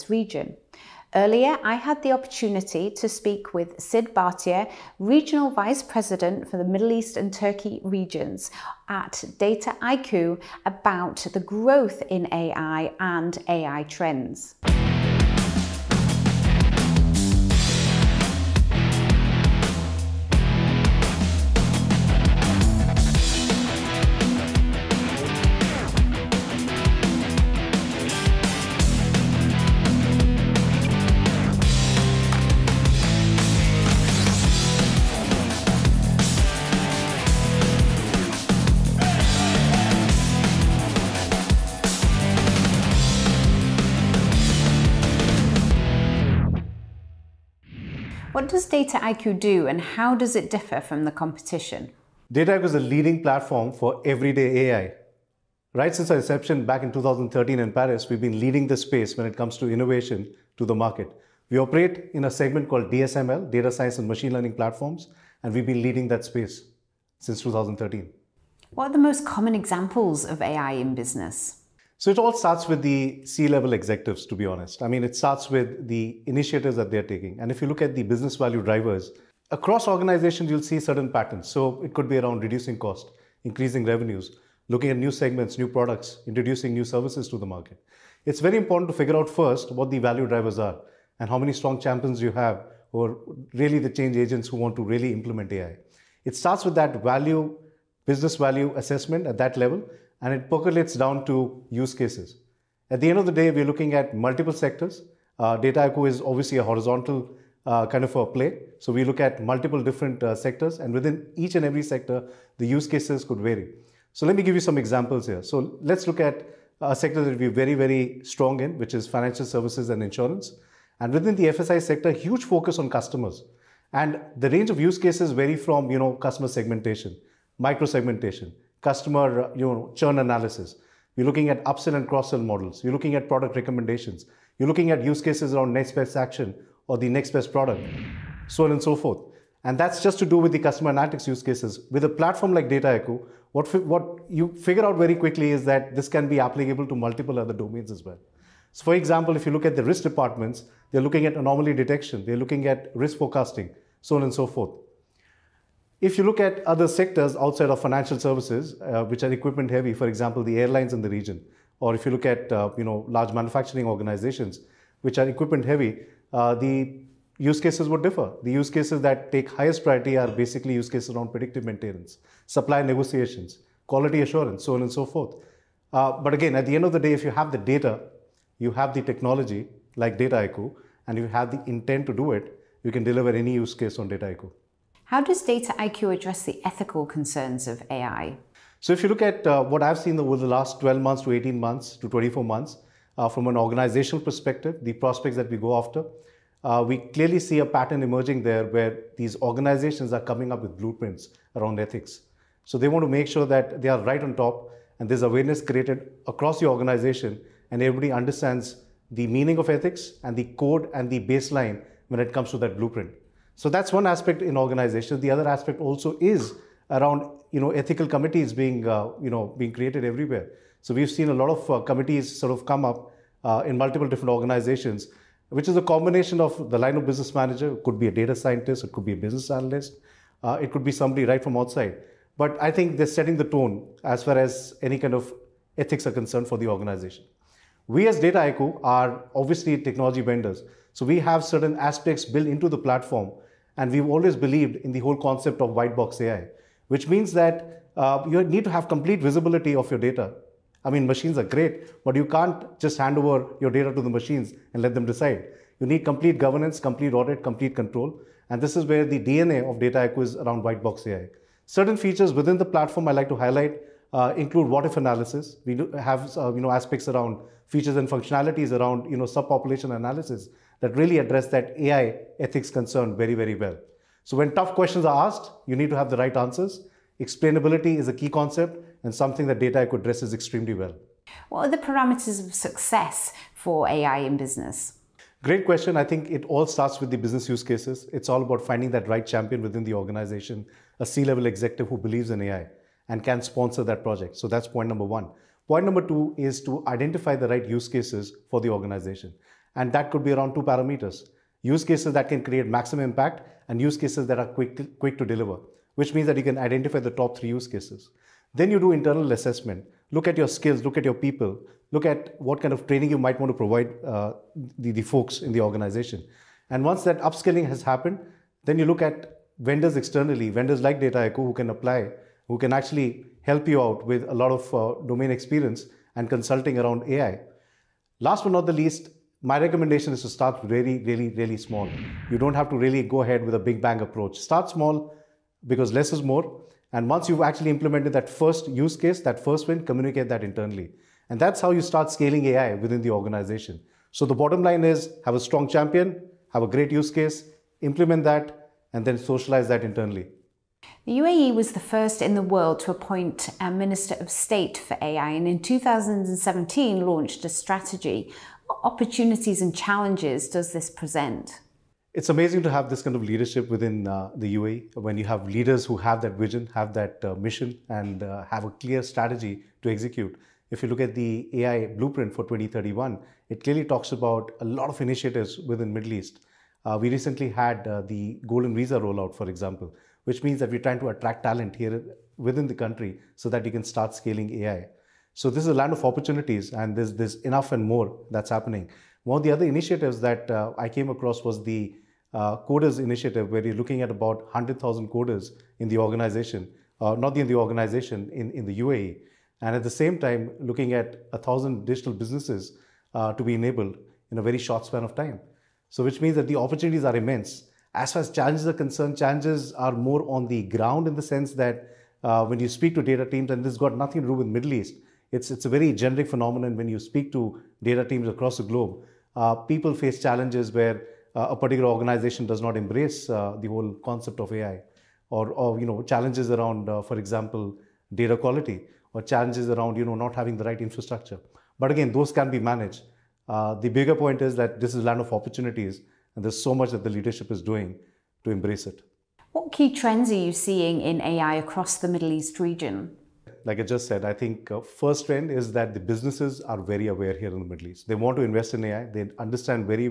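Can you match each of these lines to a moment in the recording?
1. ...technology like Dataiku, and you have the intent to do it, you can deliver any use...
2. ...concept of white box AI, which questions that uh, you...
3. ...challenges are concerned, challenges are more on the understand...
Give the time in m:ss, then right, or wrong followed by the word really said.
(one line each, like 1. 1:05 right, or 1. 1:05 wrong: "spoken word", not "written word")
1. 2:59 right
2. 4:05 wrong: "means", not "questions"
3. 6:48 wrong: "ground", not "understand".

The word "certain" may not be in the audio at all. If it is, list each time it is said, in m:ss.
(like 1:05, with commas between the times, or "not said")
1:20, 4:01, 4:21.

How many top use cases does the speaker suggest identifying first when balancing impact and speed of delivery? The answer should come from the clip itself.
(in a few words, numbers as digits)
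3.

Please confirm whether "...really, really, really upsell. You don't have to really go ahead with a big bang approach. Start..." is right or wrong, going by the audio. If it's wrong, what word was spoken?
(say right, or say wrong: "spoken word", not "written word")
wrong: "small", not "upsell".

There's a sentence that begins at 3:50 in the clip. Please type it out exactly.
Uh, it could be somebody right from outside.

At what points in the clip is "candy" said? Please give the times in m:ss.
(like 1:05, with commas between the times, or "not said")
not said.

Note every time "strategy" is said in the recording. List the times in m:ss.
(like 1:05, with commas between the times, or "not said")
5:57, 6:09.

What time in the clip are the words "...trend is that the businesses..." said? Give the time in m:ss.
7:25.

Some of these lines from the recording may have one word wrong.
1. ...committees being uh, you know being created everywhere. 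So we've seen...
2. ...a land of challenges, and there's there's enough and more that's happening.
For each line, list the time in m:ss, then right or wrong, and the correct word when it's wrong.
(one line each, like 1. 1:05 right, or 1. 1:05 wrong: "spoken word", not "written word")
1. 3:38 right
2. 6:25 wrong: "opportunities", not "challenges".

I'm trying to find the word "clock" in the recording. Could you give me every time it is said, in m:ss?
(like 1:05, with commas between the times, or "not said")
not said.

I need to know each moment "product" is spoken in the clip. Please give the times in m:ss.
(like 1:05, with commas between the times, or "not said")
1:25, 2:13, 2:17.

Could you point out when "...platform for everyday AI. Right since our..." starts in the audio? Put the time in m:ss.
0:53.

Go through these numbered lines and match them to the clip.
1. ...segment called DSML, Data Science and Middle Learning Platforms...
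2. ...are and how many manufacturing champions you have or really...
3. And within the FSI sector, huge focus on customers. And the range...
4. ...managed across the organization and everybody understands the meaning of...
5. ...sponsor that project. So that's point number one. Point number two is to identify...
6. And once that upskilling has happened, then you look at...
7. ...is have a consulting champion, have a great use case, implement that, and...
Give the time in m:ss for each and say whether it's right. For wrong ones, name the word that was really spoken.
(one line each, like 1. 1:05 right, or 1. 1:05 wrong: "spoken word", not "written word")
1. 1:02 wrong: "Machine", not "Middle"
2. 1:30 wrong: "strong", not "manufacturing"
3. 2:00 right
4. 3:25 wrong: "created", not "managed"
5. 4:53 right
6. 5:16 right
7. 5:44 wrong: "strong", not "consulting".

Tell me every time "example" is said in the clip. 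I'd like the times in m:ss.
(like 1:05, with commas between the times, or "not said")
1:09, 1:54, 2:28, 2:40, 6:19, 7:07.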